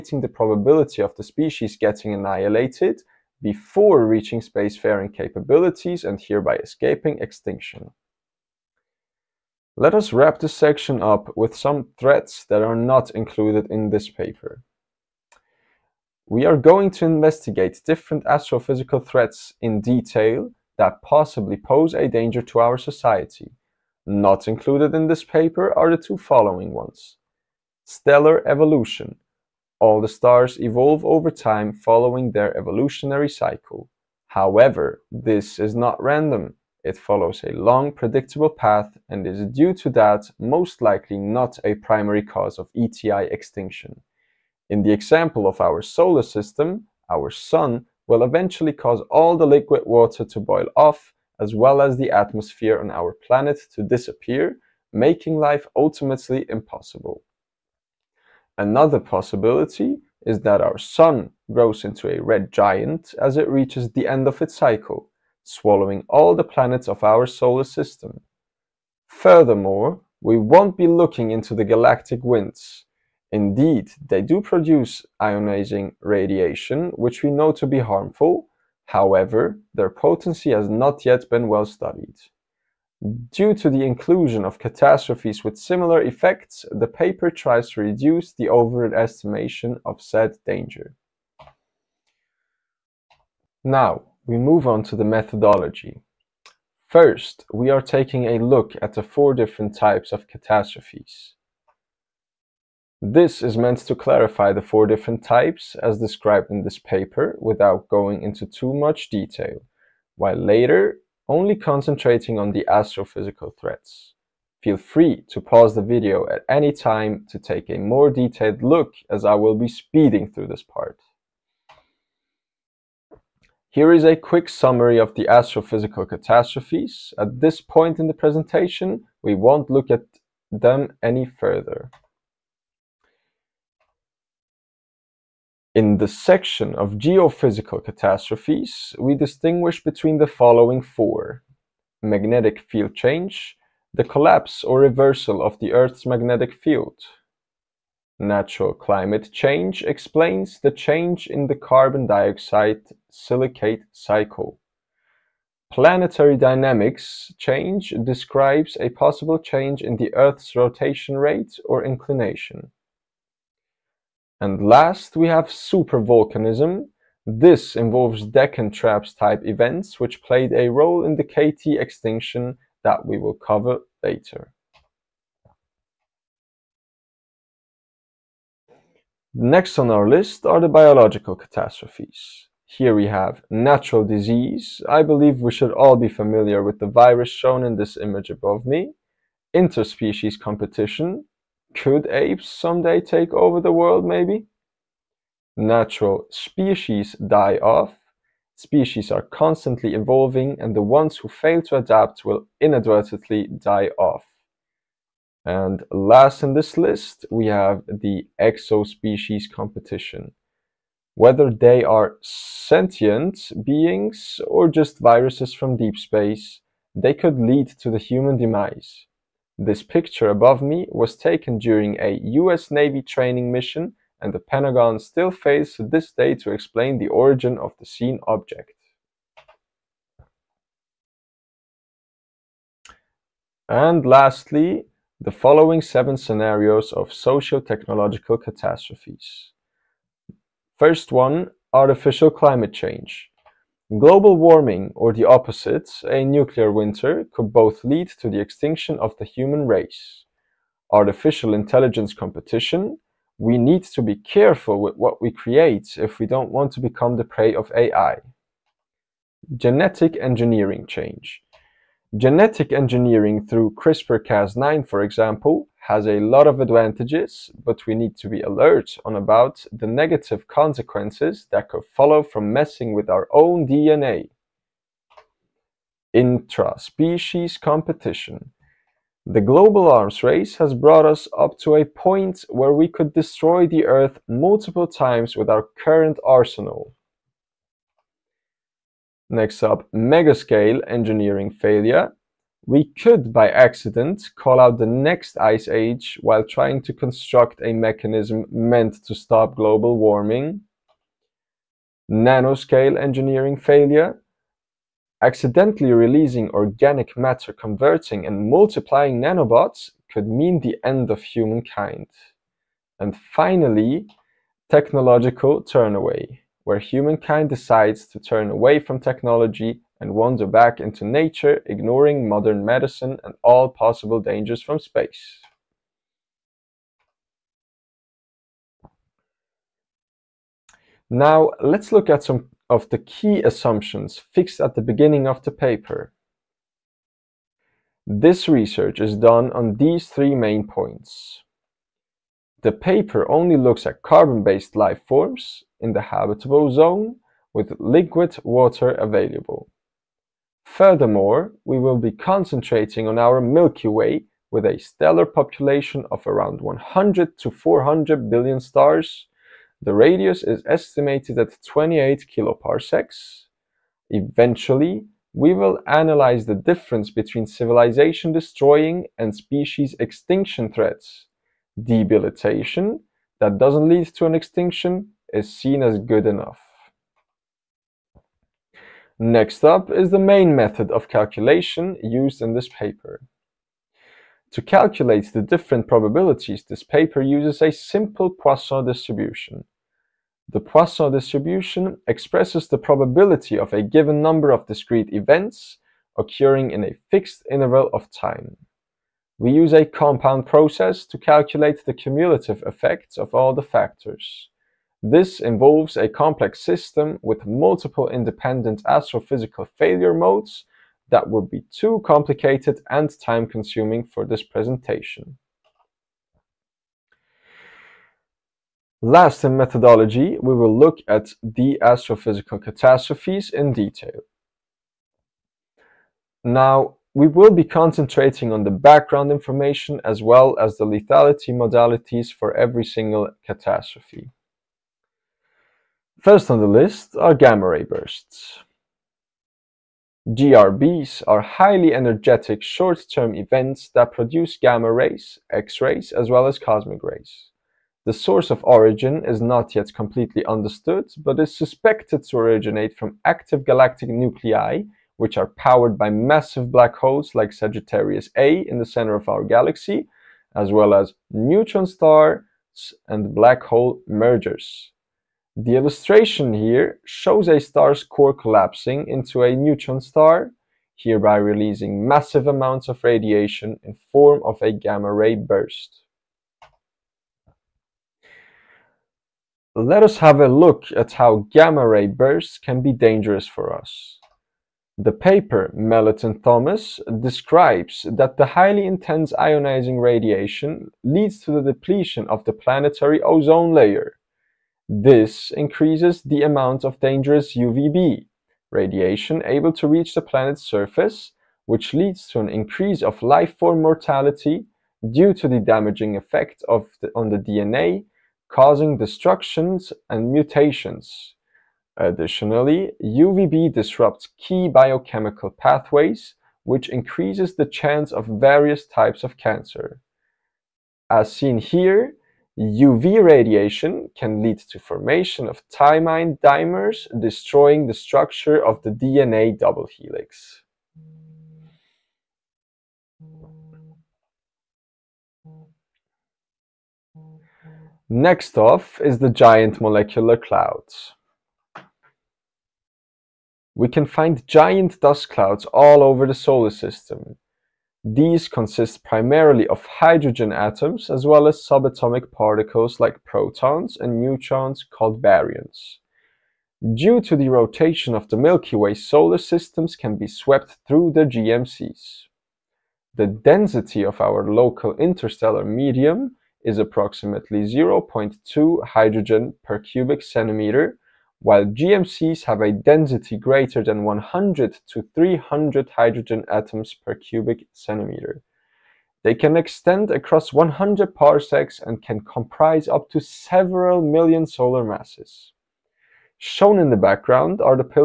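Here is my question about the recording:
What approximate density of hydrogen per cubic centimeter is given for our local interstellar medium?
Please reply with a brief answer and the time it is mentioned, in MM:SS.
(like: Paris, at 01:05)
0.2, at 09:27.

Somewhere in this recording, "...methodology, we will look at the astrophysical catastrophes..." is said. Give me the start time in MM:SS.
06:59.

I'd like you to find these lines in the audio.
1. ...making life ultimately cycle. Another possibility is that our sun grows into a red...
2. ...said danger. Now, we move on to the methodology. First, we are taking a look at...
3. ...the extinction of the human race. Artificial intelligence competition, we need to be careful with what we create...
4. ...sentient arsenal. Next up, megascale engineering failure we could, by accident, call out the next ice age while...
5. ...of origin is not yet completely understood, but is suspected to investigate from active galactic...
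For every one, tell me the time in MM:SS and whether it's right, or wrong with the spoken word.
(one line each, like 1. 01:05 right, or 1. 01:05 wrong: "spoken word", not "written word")
1. 00:54 wrong: "impossible", not "cycle"
2. 01:30 right
3. 04:08 right
4. 04:45 wrong: "current", not "sentient"
5. 07:28 wrong: "originate", not "investigate".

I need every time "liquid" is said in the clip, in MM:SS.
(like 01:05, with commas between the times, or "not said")
00:49, 05:47.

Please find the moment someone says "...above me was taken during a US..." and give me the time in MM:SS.
03:40.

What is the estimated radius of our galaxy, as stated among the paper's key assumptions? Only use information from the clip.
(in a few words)
28 kiloparsecs.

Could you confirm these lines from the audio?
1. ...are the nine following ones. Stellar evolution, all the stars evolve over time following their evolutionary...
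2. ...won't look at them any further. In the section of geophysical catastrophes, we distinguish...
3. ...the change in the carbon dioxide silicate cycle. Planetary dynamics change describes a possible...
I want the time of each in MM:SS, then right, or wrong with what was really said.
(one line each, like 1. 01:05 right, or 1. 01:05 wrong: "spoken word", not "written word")
1. 00:25 wrong: "two", not "nine"
2. 02:09 right
3. 02:30 right.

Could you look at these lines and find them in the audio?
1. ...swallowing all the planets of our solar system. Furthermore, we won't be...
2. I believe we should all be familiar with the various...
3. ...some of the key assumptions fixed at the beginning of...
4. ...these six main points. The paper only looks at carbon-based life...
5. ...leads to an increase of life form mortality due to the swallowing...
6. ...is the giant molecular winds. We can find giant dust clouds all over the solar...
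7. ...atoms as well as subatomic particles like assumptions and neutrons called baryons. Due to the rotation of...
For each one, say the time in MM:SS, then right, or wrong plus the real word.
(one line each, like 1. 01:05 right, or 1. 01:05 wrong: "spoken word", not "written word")
1. 01:05 right
2. 03:04 wrong: "virus", not "various"
3. 05:32 right
4. 05:39 wrong: "three", not "six"
5. 08:21 wrong: "damaging", not "swallowing"
6. 08:59 wrong: "clouds", not "winds"
7. 09:10 wrong: "protons", not "assumptions".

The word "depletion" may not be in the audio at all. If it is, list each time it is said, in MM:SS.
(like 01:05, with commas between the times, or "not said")
08:11.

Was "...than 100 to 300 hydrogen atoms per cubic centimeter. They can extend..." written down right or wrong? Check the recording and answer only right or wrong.
right.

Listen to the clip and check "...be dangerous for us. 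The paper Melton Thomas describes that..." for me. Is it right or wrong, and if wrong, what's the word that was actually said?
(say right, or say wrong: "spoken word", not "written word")
right.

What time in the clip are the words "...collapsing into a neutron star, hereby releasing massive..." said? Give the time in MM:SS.
07:48.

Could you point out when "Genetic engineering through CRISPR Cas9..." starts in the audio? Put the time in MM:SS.
04:22.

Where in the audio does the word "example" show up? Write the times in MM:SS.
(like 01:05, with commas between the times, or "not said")
00:44, 04:25.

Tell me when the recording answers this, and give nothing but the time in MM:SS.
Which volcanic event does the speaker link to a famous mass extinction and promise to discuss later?
02:48.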